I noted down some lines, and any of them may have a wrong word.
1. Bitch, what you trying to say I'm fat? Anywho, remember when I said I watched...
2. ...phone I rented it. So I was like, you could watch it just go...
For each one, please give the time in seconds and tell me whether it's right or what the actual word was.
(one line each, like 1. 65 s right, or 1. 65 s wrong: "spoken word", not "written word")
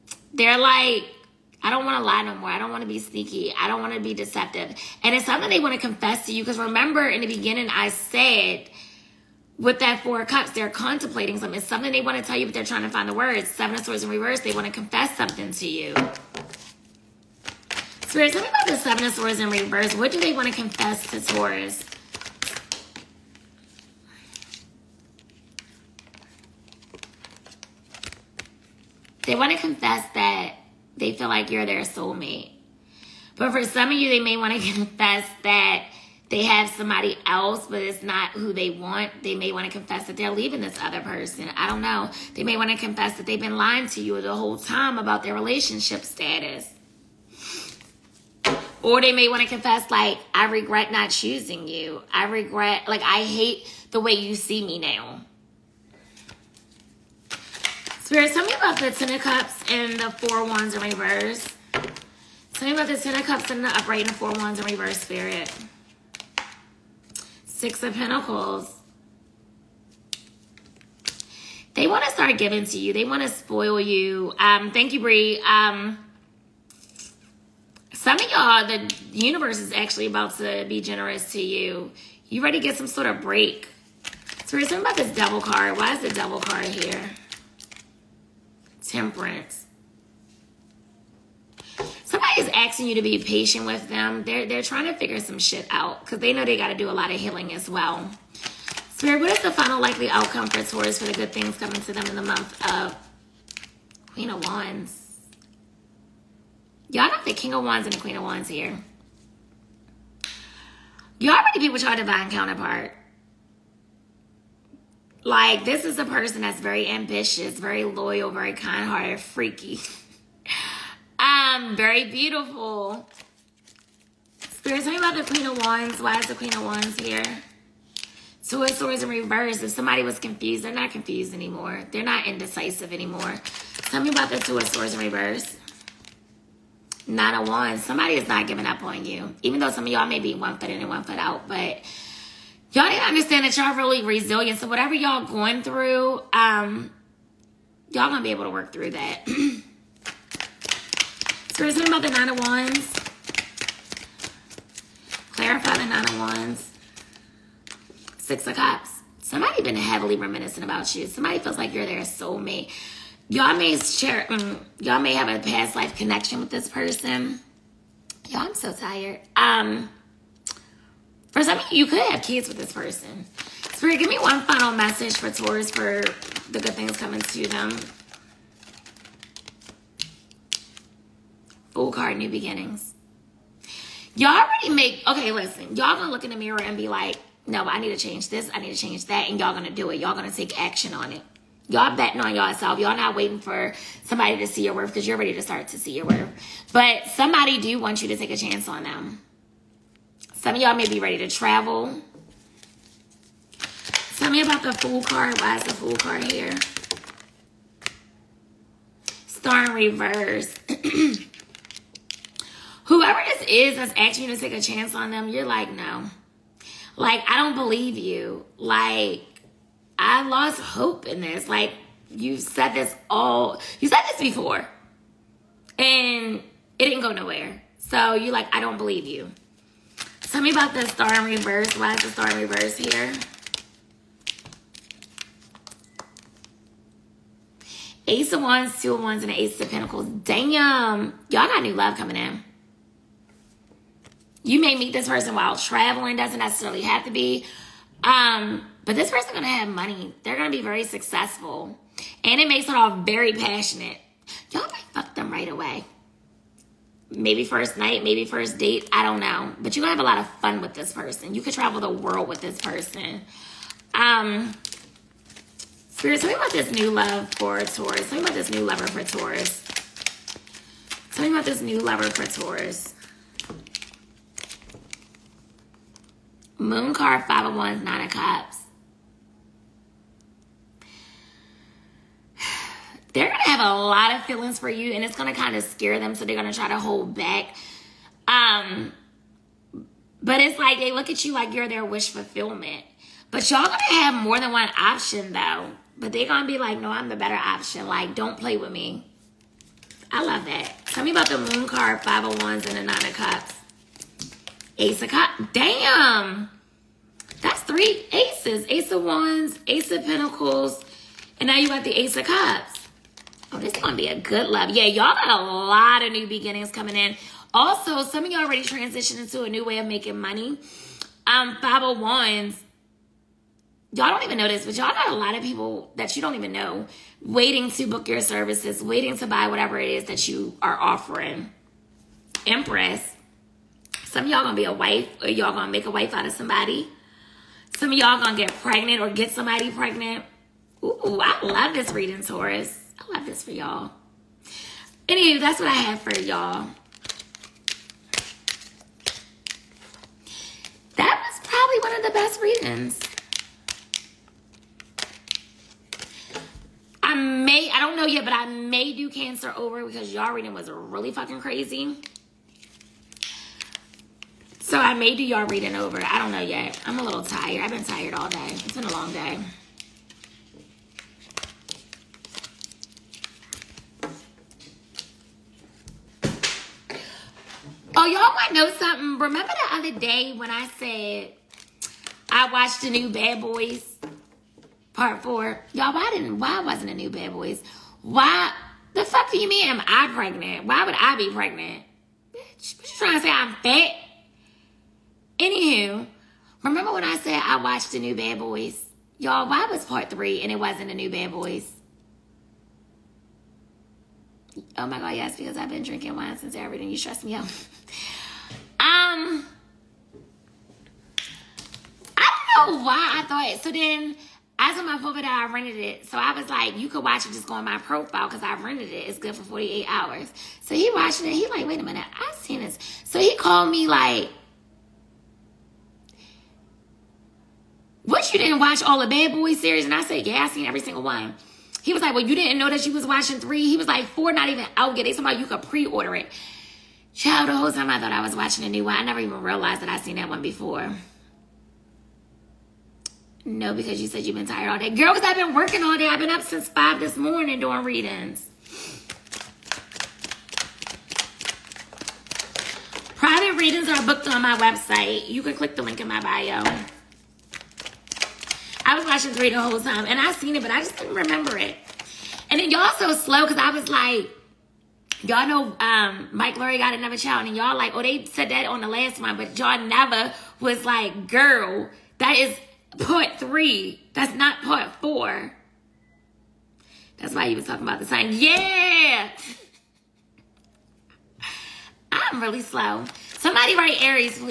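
1. 392 s right
2. 414 s right.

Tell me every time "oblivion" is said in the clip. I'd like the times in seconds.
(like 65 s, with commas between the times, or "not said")
not said.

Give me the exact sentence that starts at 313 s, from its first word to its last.
Oh, this is going to be a good love.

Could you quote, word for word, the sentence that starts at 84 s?
So talking about this devil card.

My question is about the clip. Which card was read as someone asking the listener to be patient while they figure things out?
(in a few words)
Temperance.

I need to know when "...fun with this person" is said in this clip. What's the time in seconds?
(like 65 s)
260 s.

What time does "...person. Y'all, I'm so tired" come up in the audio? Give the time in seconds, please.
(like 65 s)
166 s.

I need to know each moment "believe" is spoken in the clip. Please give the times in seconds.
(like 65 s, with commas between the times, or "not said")
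217 s, 228 s.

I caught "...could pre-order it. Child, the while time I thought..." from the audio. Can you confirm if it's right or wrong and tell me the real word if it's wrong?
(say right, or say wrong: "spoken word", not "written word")
wrong: "whole", not "while".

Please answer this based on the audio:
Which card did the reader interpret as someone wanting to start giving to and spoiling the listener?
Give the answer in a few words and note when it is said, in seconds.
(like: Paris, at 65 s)
Six of Pentacles, at 67 s.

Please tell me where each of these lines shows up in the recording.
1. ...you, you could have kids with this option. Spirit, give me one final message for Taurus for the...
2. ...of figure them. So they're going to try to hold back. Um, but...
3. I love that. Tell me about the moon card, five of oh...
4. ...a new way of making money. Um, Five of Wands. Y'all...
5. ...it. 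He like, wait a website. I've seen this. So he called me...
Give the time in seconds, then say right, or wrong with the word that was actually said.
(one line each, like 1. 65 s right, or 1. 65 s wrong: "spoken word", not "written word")
1. 171 s wrong: "person", not "option"
2. 285 s wrong: "scare", not "figure"
3. 300 s right
4. 319 s right
5. 421 s wrong: "minute", not "website".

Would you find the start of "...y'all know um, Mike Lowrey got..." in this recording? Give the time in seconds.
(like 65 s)
465 s.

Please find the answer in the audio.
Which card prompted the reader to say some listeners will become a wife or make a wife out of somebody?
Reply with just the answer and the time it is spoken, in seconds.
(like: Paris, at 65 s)
Empress, at 332 s.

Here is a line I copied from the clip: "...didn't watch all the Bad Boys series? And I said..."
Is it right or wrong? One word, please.
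right.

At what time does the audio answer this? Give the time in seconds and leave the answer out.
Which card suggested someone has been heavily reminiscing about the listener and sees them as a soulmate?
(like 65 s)
158 s.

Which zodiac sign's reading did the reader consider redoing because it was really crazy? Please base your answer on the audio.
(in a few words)
Cancer.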